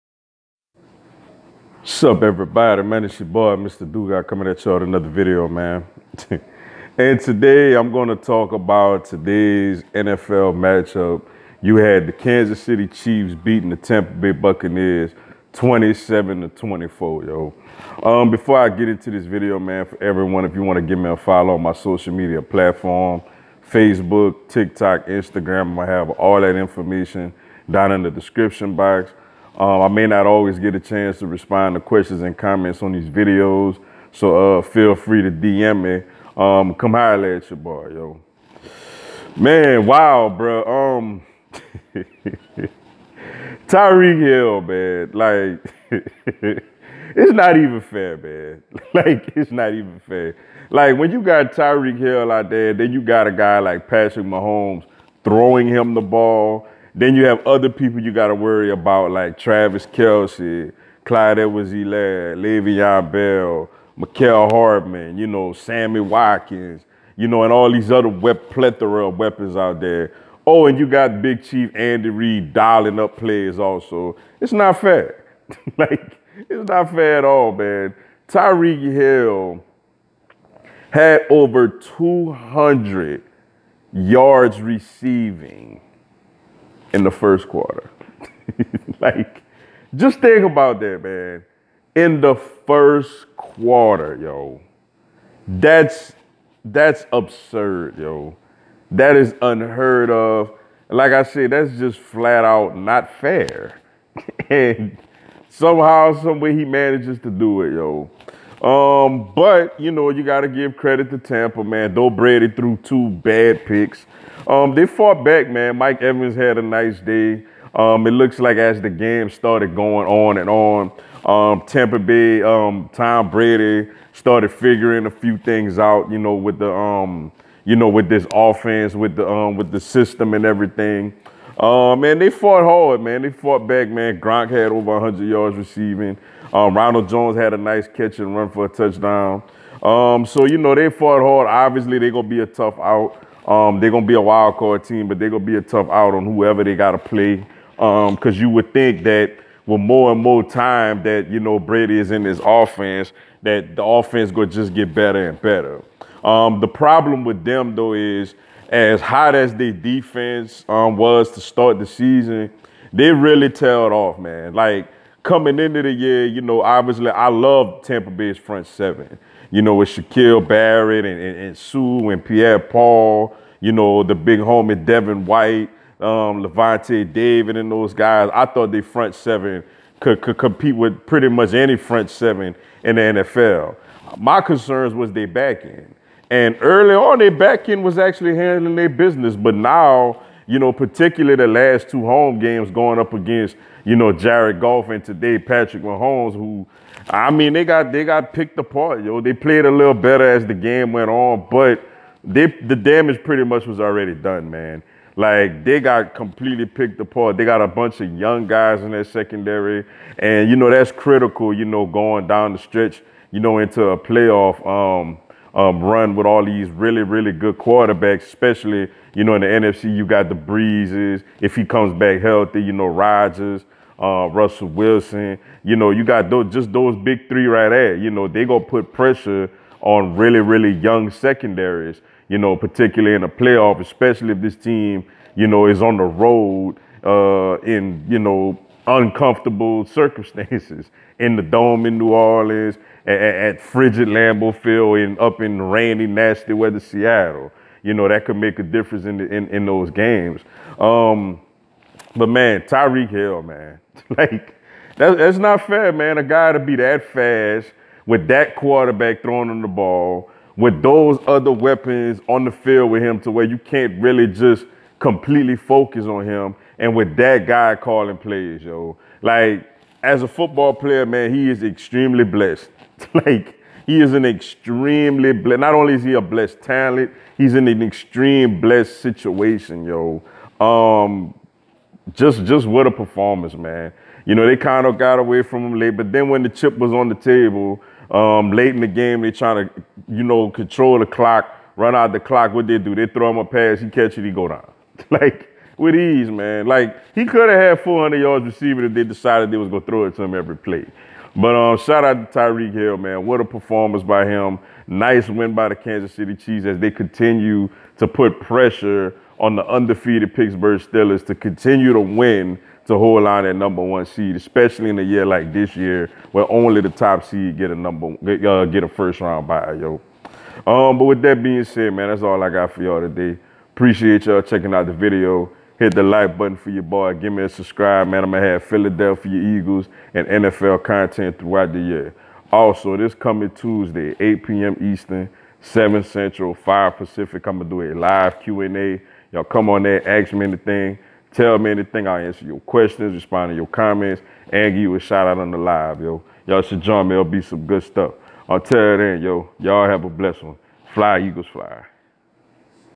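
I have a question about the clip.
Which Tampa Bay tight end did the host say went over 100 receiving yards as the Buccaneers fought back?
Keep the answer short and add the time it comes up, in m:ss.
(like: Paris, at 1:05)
Gronk, at 2:14.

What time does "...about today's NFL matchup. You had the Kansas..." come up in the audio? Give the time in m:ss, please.
0:08.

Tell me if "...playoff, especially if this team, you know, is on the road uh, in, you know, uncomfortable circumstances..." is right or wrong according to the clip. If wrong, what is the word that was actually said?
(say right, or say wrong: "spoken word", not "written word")
right.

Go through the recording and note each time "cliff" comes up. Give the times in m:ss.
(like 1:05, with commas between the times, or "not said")
not said.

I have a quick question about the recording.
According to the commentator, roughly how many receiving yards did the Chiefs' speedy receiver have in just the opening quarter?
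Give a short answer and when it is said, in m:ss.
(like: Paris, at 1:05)
over 200, at 1:21.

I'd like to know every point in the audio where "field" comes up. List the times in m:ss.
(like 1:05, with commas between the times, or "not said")
4:04, 4:22.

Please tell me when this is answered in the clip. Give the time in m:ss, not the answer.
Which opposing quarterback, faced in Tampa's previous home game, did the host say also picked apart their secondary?
3:14.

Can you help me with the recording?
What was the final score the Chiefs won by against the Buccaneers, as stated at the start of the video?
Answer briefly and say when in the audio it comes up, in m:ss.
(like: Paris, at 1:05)
27 to 24, at 0:15.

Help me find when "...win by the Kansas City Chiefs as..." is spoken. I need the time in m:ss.
5:05.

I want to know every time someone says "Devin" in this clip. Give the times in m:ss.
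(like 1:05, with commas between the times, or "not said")
2:54.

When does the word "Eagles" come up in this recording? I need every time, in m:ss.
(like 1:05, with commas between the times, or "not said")
5:29, 5:51.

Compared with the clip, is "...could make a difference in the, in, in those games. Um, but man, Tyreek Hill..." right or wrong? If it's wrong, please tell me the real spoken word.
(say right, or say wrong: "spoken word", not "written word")
right.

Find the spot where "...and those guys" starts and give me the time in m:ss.
2:57.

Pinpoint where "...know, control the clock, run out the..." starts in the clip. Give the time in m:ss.
4:50.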